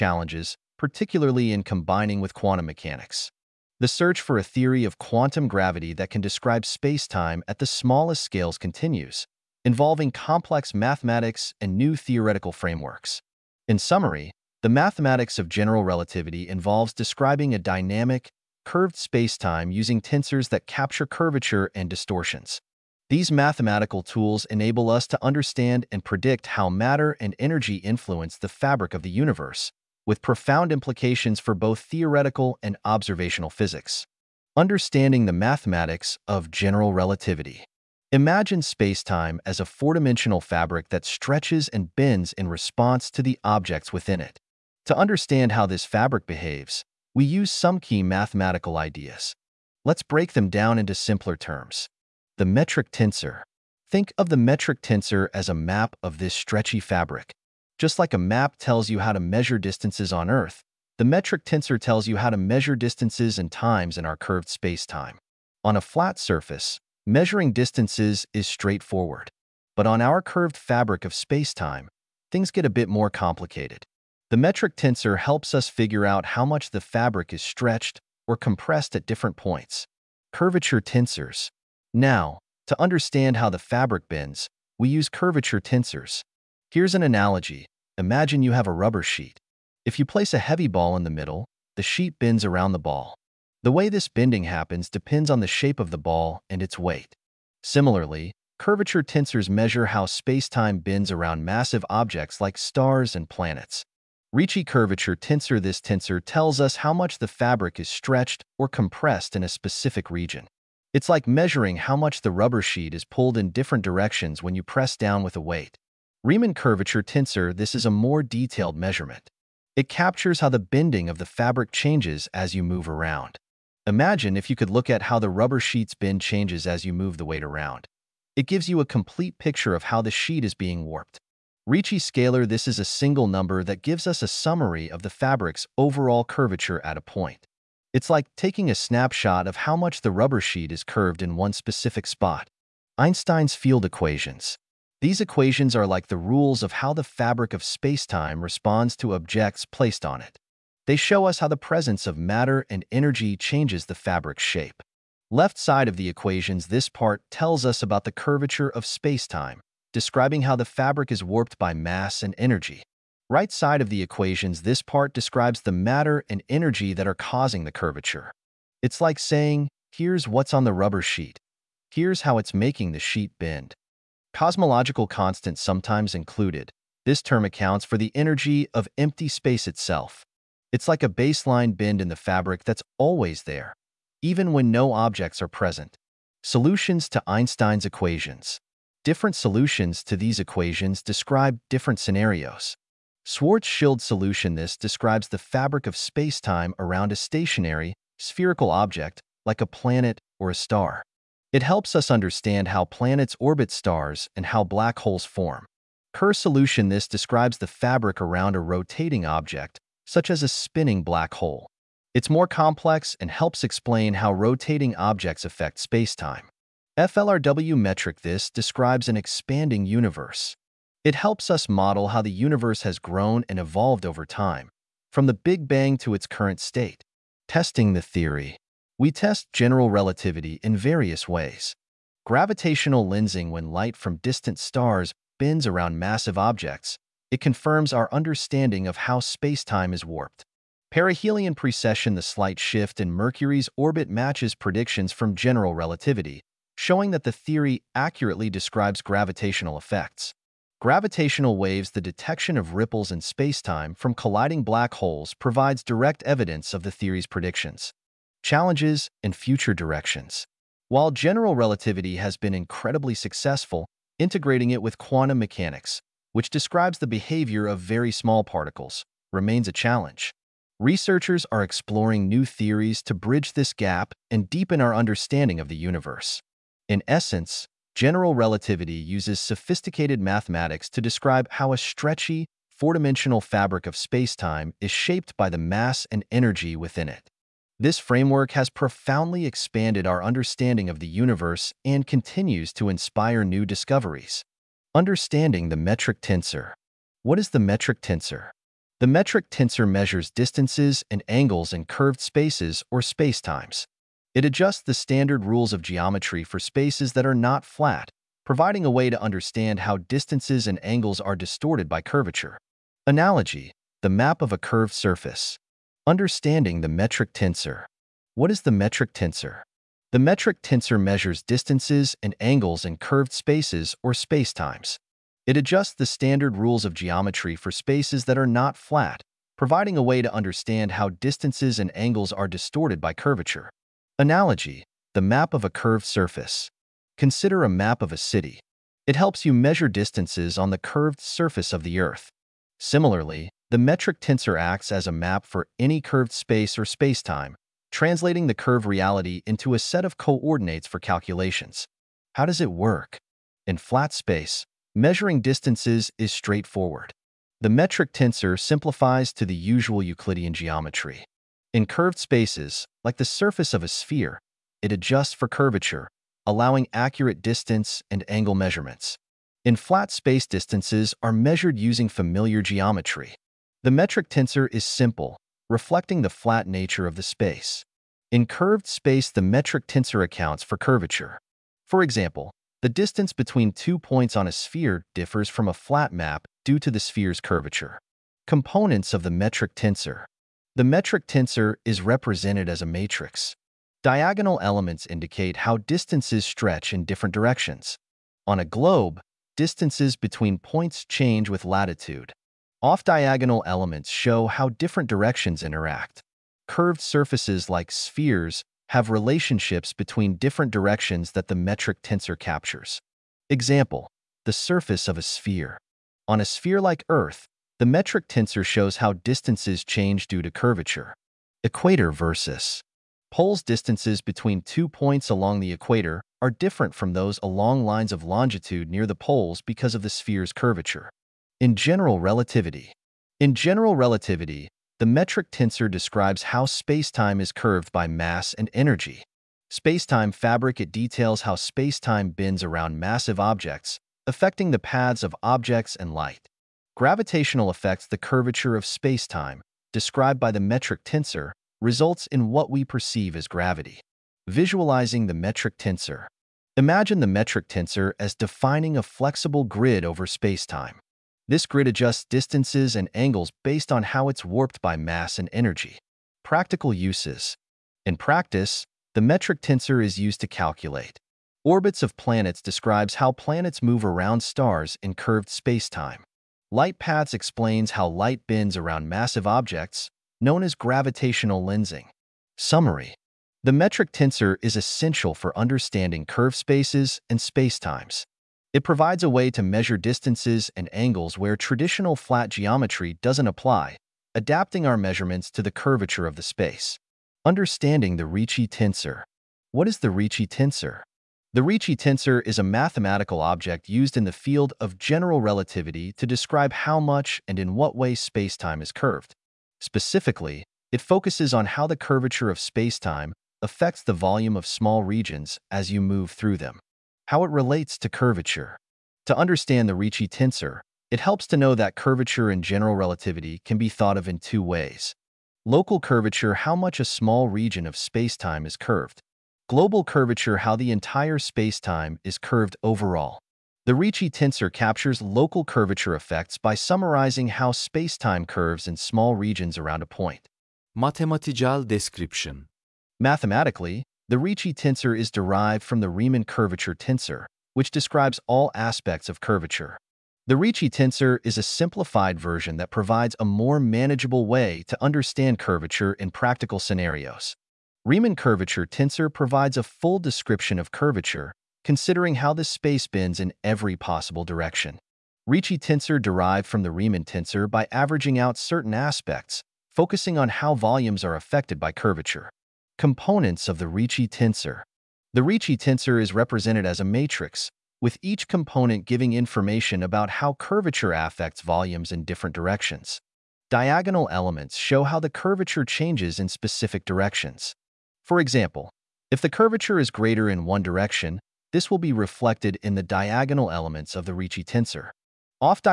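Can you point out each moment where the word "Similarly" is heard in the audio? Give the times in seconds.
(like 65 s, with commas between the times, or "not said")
97 s, 342 s.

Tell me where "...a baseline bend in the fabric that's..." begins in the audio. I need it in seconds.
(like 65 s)
181 s.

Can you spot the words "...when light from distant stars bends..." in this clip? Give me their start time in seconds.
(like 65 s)
233 s.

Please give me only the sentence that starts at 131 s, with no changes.
Ricci scalar This is a single number that gives us a summary of the fabric's overall curvature at a point.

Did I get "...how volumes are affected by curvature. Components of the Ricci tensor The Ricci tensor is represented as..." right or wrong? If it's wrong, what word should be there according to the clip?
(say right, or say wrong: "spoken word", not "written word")
right.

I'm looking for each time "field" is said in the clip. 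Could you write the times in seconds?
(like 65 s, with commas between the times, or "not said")
143 s, 504 s.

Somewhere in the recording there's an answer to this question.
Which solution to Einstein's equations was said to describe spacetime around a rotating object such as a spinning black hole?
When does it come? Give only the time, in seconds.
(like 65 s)
206 s.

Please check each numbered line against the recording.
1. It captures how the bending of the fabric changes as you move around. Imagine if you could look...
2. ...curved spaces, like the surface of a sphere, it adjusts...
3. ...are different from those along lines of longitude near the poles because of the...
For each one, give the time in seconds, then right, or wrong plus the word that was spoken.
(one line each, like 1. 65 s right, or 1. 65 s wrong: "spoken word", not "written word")
1. 119 s right
2. 361 s right
3. 426 s right.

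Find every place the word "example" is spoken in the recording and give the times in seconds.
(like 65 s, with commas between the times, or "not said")
382 s, 413 s, 588 s.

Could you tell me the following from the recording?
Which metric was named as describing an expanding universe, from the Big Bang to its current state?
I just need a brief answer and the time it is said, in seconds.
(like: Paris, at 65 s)
FLRW metric, at 216 s.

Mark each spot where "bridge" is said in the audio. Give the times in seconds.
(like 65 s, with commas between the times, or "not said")
273 s.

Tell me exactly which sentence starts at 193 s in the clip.
Schwarzschild solution this describes the fabric of spacetime around a stationary, spherical object, like a planet or a star.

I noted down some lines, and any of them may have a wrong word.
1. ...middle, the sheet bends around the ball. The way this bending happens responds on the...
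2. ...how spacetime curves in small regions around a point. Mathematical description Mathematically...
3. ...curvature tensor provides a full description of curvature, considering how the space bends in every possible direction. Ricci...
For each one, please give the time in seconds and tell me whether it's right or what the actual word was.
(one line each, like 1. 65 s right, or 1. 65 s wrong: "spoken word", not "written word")
1. 91 s wrong: "depends", not "responds"
2. 537 s right
3. 558 s right.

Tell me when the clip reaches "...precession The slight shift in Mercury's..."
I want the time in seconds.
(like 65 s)
241 s.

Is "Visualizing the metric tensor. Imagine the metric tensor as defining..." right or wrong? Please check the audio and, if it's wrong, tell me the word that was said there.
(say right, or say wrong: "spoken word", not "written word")
right.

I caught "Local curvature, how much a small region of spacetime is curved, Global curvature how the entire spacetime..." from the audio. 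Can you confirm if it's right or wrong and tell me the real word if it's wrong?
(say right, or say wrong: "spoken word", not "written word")
right.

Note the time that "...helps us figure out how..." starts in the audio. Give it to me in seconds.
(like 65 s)
75 s.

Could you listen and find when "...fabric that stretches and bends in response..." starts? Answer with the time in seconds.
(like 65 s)
40 s.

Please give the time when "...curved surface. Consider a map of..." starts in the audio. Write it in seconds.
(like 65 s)
335 s.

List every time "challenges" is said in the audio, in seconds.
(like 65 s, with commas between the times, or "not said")
258 s, 269 s.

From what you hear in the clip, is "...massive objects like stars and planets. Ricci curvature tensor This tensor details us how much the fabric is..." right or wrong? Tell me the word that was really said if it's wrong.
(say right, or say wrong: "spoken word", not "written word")
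wrong: "tells", not "details".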